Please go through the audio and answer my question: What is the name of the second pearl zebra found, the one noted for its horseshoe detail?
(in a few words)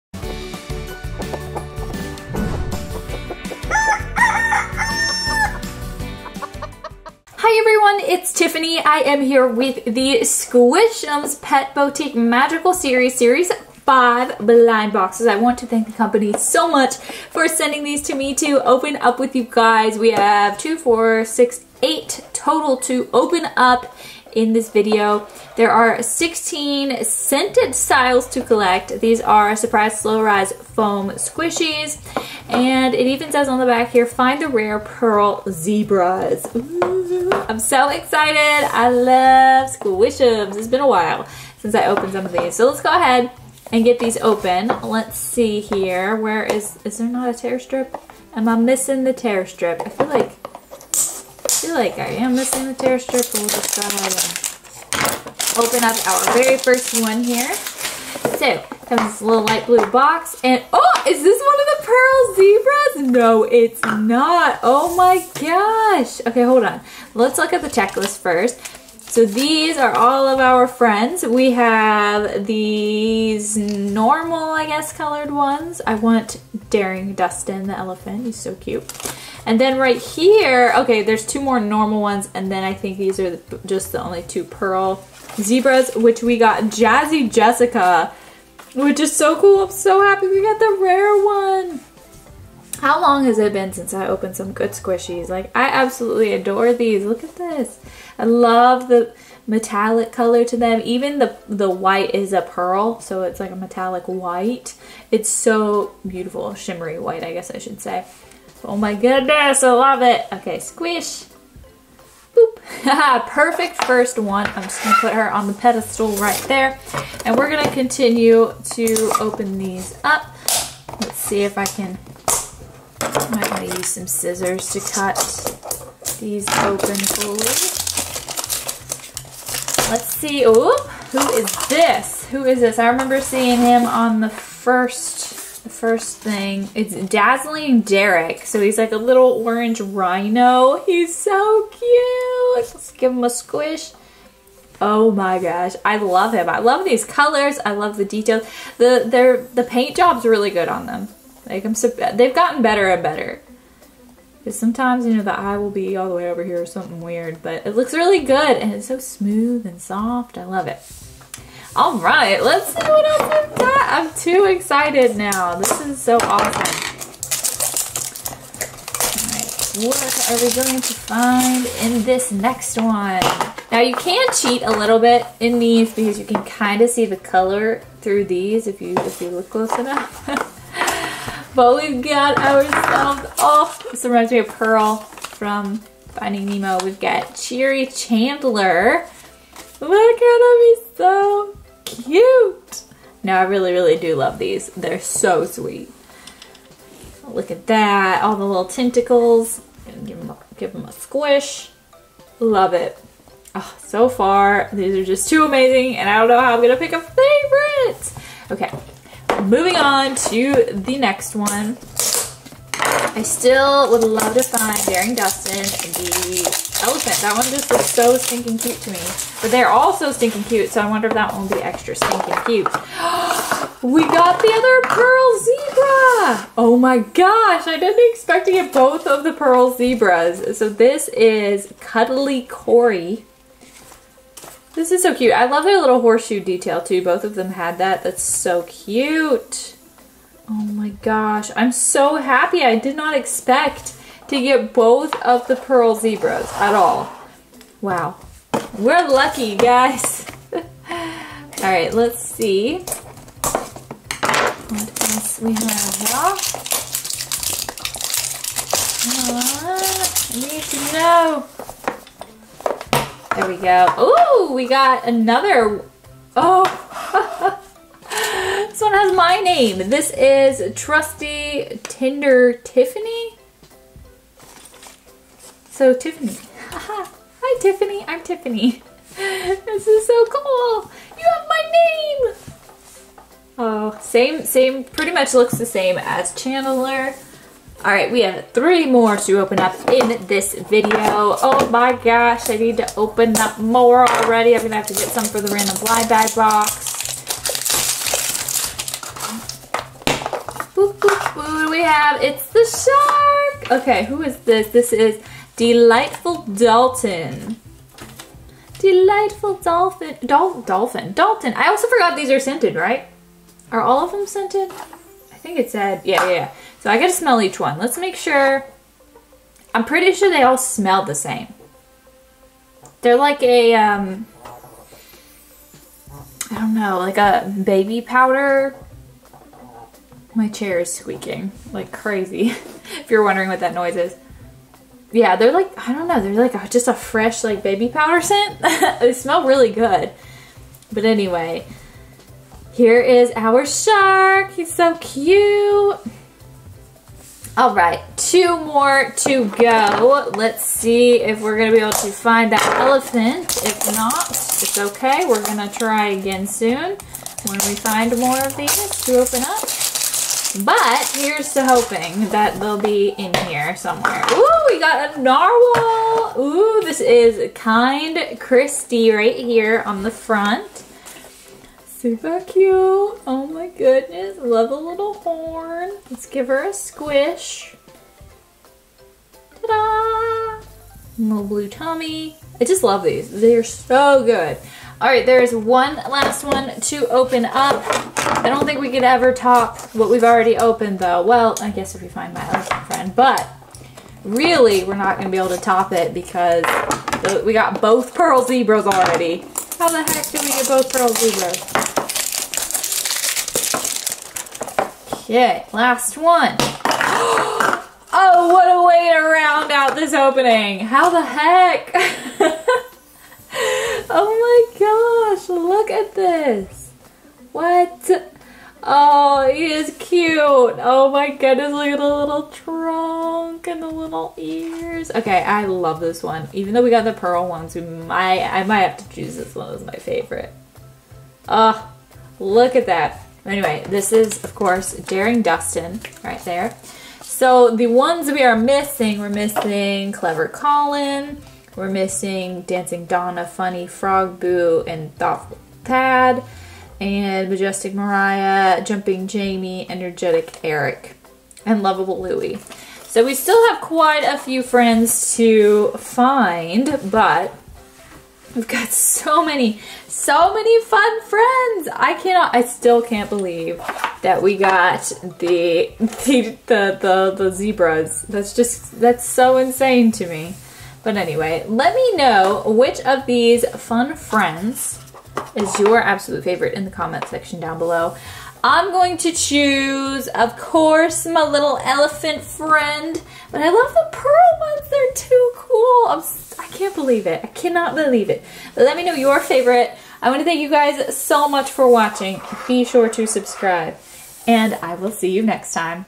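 Cuddly Cory.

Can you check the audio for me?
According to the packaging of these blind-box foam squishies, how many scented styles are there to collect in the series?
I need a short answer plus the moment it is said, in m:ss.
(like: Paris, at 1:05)
16, at 0:26.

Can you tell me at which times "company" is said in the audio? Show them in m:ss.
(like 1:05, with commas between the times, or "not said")
0:15.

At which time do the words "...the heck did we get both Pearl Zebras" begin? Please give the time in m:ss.
6:39.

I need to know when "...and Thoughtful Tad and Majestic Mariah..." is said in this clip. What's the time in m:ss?
7:24.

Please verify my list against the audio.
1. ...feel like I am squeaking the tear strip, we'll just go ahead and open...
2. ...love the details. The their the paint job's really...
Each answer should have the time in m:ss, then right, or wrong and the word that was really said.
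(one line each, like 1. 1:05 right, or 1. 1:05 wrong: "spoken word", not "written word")
1. 0:51 wrong: "missing", not "squeaking"
2. 2:27 right.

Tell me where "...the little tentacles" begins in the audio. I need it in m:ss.
3:18.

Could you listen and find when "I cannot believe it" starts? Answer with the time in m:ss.
8:07.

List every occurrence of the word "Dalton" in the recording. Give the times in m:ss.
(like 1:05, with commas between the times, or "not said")
5:06, 5:11.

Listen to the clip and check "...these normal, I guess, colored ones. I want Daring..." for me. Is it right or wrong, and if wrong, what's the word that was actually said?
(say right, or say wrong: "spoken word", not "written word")
right.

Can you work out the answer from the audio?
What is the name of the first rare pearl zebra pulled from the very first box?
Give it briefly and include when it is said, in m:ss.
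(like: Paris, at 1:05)
Jazzy Jessica, at 1:26.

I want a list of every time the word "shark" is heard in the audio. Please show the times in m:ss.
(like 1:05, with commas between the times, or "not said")
5:03, 5:43.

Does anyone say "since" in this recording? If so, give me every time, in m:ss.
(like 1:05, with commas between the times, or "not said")
0:41, 1:33.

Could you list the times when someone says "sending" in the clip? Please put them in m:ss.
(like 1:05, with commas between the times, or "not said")
0:17.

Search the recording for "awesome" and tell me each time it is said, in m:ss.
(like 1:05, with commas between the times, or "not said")
2:46.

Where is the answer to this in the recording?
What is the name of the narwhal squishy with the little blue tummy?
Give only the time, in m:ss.
6:07.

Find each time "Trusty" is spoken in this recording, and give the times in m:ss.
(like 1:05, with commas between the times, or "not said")
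4:30.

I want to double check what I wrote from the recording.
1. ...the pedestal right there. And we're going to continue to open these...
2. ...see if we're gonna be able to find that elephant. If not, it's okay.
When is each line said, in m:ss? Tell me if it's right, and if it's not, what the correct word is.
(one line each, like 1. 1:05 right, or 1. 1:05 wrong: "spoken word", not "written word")
1. 1:55 right
2. 5:50 right.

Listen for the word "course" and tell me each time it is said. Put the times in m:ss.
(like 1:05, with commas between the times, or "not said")
7:14, 8:00.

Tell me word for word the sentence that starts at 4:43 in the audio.
Oh, same, same, pretty much looks the same as Chandler.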